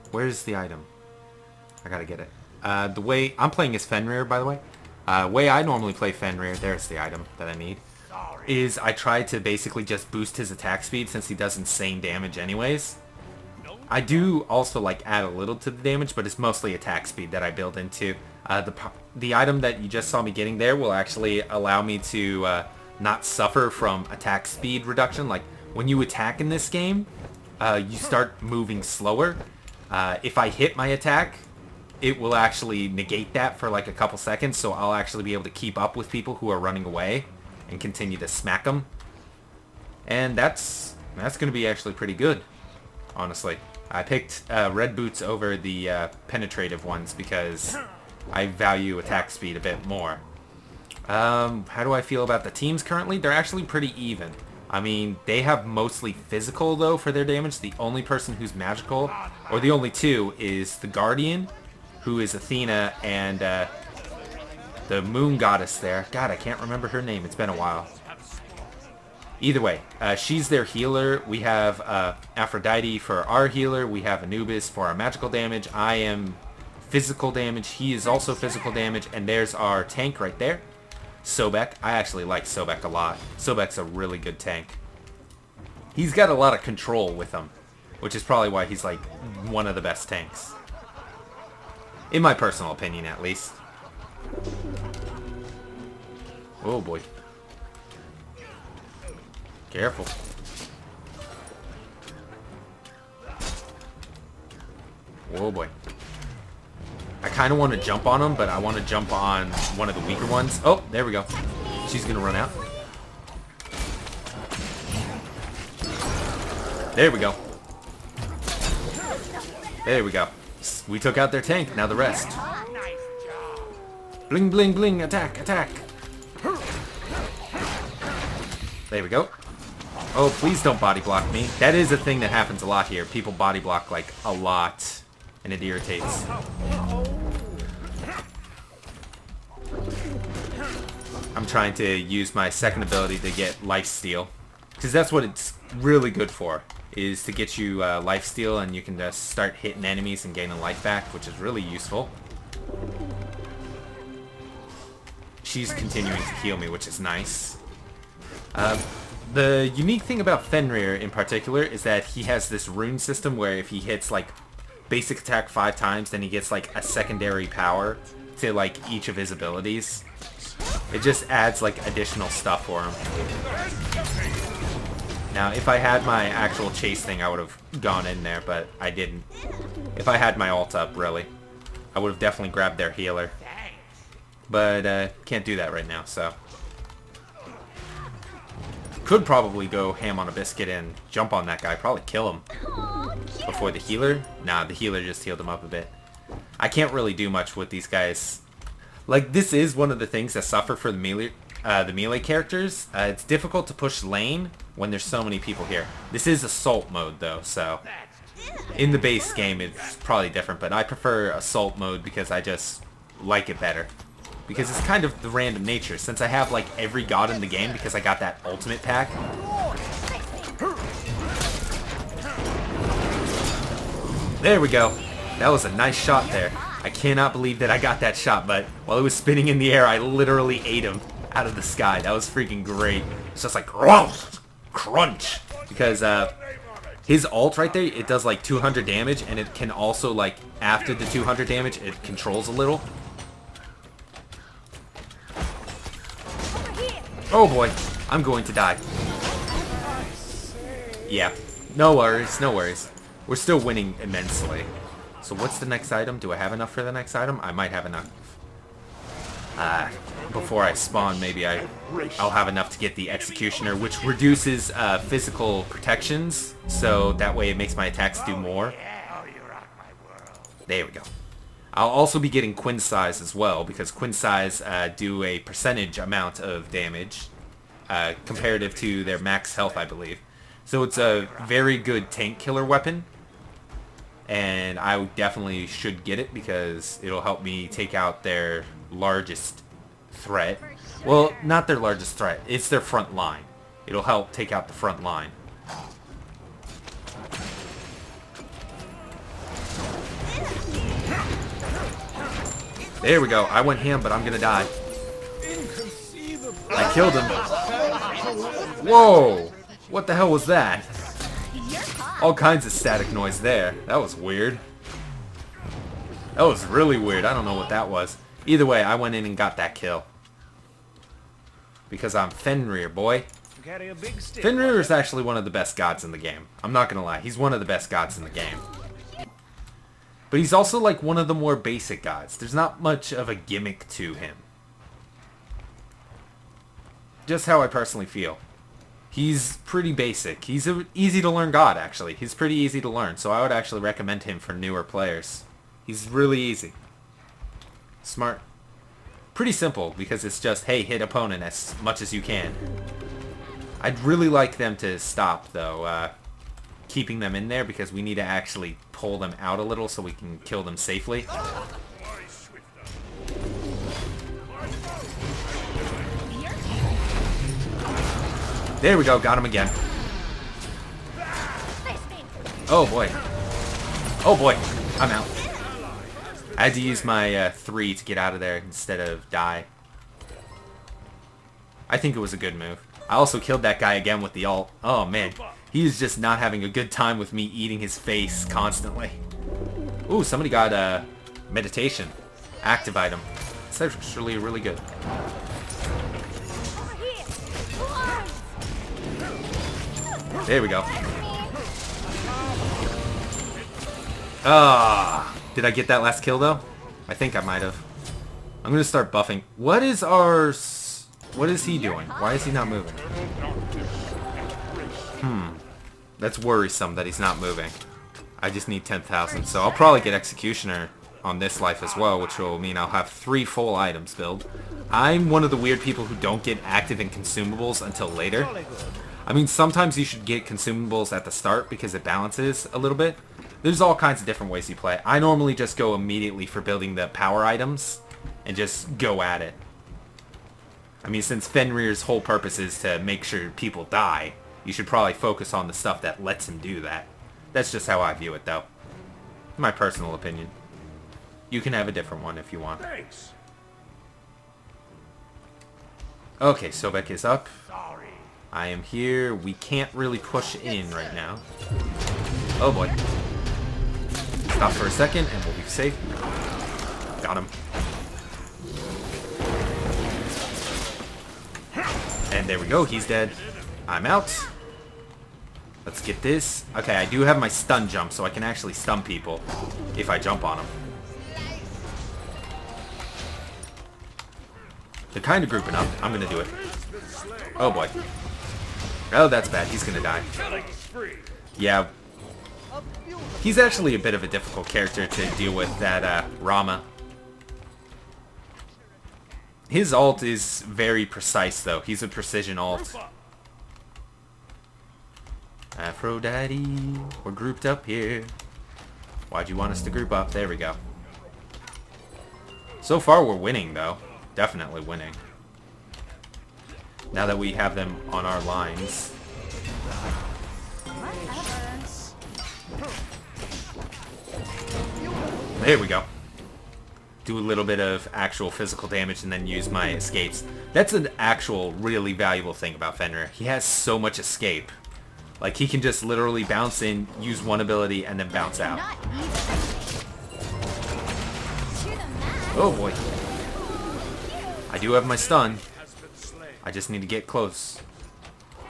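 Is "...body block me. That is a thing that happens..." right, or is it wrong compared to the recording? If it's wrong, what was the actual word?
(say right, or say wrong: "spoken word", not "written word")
right.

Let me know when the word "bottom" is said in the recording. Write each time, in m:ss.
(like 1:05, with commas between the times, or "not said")
not said.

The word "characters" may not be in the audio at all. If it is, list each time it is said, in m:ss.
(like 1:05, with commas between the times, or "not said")
3:22, 8:14.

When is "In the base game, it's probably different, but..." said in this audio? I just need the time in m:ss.
3:28.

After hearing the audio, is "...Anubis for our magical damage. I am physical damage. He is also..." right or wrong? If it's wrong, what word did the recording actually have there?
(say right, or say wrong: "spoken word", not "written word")
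right.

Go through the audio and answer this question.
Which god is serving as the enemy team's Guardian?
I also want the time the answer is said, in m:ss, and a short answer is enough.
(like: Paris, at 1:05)
Athena, at 1:02.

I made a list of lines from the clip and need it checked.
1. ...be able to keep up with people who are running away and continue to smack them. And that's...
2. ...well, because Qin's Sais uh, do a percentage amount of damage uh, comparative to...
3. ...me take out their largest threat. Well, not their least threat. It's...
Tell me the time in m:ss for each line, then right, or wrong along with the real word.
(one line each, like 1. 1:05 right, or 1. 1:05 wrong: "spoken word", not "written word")
1. 0:35 right
2. 4:33 right
3. 4:47 wrong: "largest", not "least".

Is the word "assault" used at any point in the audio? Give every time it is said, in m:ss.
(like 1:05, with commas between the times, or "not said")
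3:26, 3:31.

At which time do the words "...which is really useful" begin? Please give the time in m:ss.
2:31.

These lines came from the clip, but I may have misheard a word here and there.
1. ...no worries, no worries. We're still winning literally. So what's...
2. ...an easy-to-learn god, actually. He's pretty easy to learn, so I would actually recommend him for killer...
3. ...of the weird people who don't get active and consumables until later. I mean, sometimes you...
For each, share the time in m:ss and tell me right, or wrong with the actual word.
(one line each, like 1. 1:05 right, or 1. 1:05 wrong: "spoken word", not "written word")
1. 4:11 wrong: "immensely", not "literally"
2. 5:40 wrong: "newer", not "killer"
3. 7:05 right.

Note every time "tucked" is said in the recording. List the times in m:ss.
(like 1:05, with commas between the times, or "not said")
not said.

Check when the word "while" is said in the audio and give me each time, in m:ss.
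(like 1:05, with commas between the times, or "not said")
1:07, 3:48.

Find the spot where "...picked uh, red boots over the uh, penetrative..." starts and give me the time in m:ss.
0:44.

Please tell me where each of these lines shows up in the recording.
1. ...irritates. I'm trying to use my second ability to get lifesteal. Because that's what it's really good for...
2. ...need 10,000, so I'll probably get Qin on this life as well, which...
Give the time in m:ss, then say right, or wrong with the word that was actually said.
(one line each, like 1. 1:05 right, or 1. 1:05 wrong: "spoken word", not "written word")
1. 2:15 right
2. 6:58 wrong: "Executioner", not "Qin".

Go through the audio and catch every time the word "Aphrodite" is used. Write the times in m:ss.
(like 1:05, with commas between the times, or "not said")
1:12, 8:25.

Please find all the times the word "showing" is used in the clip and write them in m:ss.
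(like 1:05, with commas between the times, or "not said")
not said.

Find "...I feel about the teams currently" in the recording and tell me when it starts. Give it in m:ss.
0:51.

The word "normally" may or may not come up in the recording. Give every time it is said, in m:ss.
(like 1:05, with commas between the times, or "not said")
0:05, 7:15.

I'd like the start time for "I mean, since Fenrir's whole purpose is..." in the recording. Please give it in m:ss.
7:21.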